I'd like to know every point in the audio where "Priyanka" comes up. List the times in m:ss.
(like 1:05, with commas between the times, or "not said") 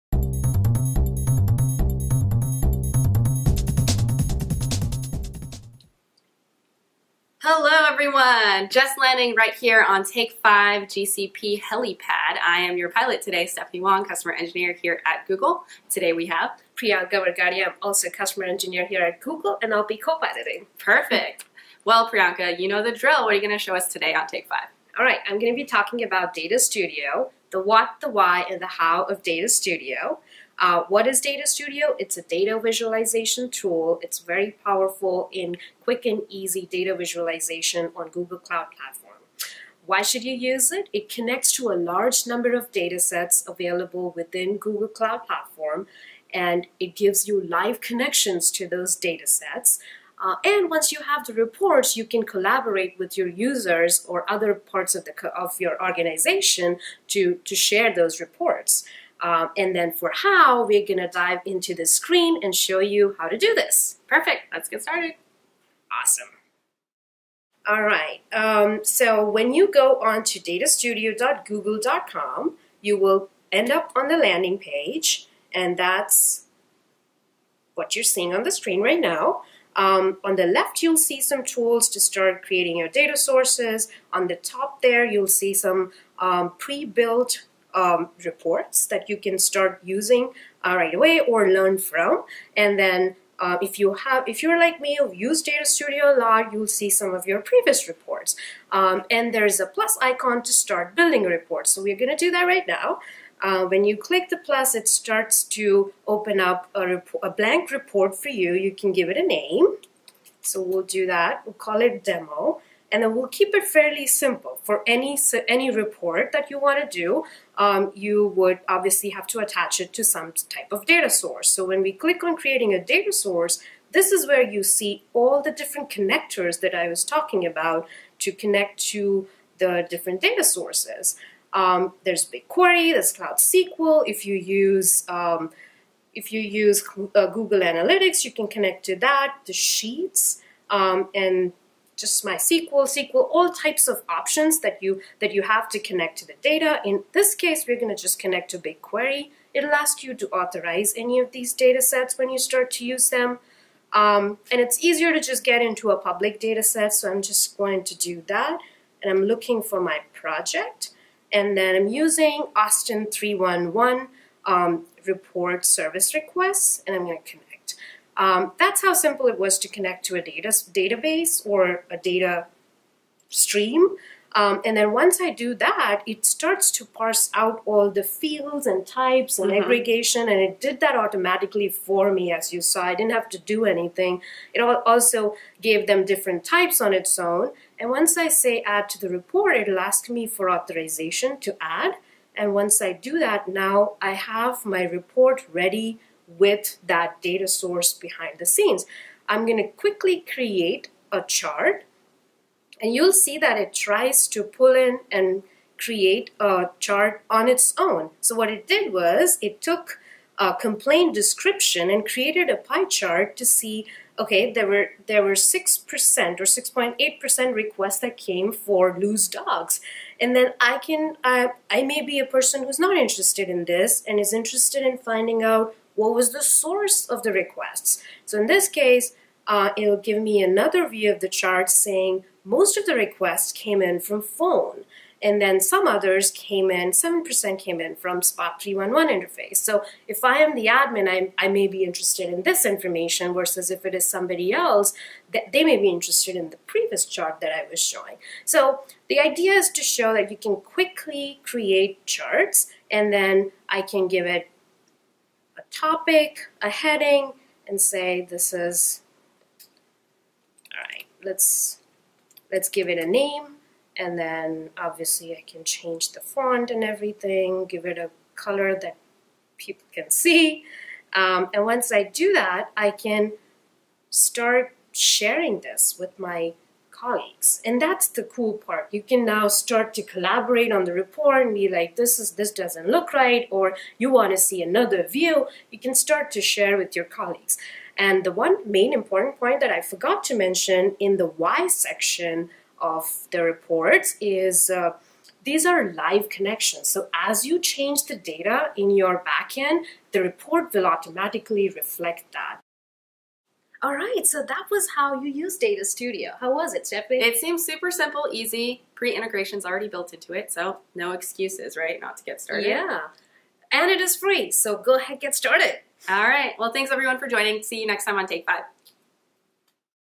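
0:16, 0:22.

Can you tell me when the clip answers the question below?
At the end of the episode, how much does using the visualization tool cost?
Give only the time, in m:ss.
5:13.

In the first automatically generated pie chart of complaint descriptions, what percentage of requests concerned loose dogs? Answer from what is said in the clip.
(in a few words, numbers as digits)
6.8%.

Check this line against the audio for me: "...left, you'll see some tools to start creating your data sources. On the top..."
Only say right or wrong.
right.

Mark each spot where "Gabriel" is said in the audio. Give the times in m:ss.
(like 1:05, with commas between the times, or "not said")
not said.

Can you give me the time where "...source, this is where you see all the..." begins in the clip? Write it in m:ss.
2:03.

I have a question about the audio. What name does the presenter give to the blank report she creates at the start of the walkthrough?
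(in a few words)
demo.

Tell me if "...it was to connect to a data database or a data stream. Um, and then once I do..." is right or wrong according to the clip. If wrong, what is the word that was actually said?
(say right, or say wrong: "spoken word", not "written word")
right.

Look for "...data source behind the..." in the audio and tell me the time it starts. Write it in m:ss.
3:17.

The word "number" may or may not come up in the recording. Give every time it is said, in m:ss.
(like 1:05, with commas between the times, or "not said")
0:42.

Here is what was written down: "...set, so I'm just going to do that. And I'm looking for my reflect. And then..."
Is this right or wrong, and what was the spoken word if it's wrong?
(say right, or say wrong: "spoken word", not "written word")
wrong: "project", not "reflect".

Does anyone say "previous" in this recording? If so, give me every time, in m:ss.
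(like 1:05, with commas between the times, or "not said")
1:37, 4:06.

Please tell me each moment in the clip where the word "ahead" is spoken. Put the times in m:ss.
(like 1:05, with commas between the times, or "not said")
5:14.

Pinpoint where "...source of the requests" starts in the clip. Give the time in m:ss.
3:46.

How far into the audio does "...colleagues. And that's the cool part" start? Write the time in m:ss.
4:37.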